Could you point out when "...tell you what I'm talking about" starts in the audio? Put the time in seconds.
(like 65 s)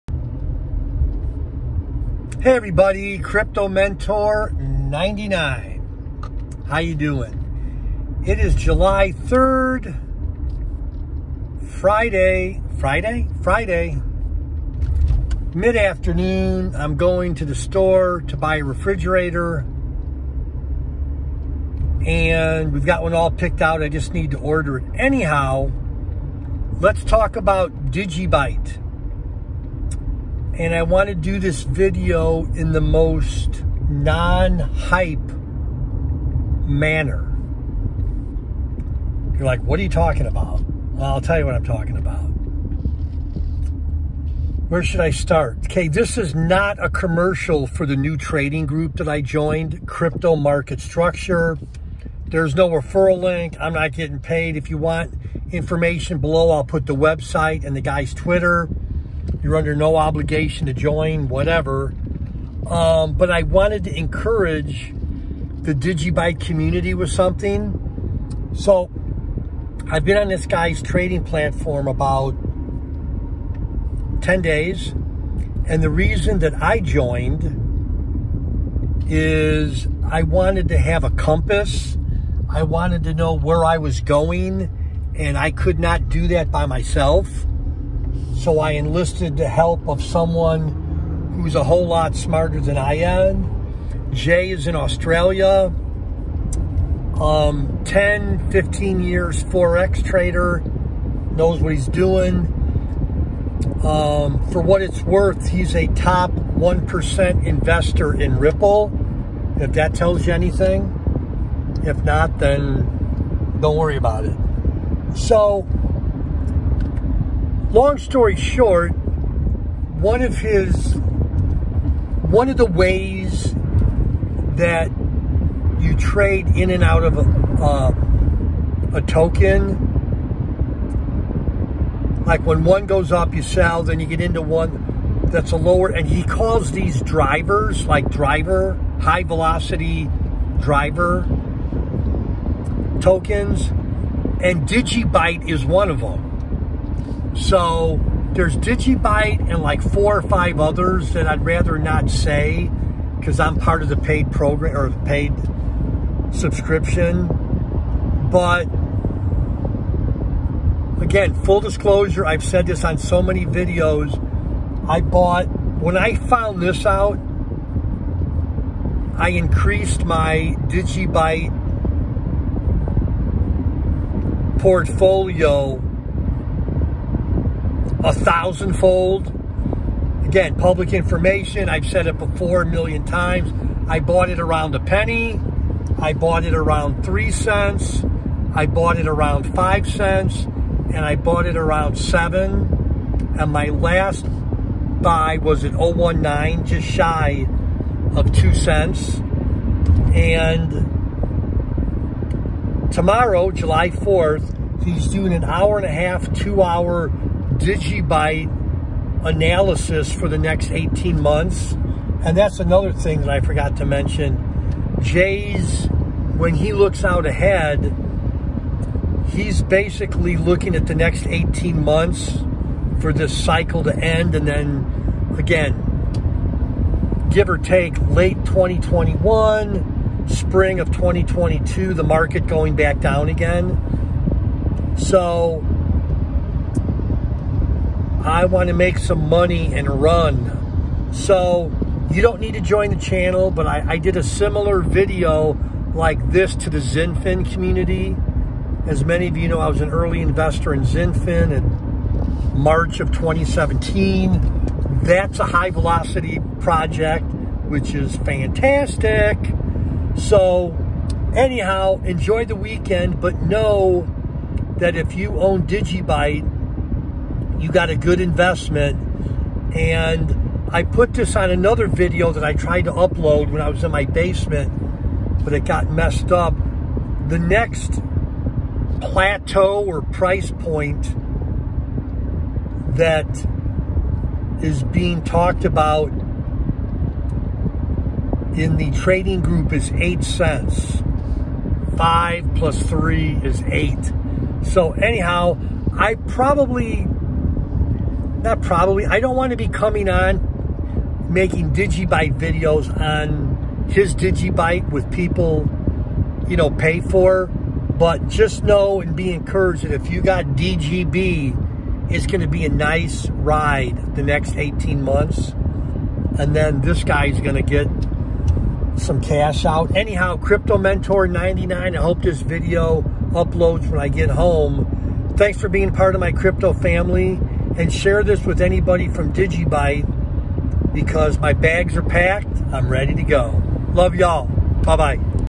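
41 s.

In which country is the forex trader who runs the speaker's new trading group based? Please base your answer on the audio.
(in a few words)
Australia.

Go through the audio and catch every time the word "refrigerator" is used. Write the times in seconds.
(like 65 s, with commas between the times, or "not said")
18 s.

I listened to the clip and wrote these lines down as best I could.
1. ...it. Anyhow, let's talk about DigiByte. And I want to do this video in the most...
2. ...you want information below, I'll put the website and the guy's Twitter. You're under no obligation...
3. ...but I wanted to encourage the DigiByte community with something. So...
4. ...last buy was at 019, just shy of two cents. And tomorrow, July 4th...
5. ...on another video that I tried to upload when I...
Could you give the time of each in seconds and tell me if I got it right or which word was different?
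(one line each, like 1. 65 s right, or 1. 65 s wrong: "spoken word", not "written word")
1. 24 s right
2. 54 s right
3. 63 s right
4. 193 s right
5. 271 s right.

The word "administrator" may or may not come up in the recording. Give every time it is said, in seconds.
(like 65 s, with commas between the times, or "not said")
not said.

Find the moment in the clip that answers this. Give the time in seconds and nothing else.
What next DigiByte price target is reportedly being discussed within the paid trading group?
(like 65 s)
289 s.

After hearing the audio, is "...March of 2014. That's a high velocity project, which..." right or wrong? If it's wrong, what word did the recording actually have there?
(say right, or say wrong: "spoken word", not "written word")
wrong: "2017", not "2014".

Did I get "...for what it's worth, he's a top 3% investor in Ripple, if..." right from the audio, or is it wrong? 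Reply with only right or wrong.
wrong.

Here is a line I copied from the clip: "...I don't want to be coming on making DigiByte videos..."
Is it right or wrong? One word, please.
right.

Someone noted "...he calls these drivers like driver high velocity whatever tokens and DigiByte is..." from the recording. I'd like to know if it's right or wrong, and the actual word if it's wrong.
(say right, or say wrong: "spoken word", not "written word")
wrong: "driver", not "whatever".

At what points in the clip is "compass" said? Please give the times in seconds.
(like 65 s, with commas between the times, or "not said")
81 s.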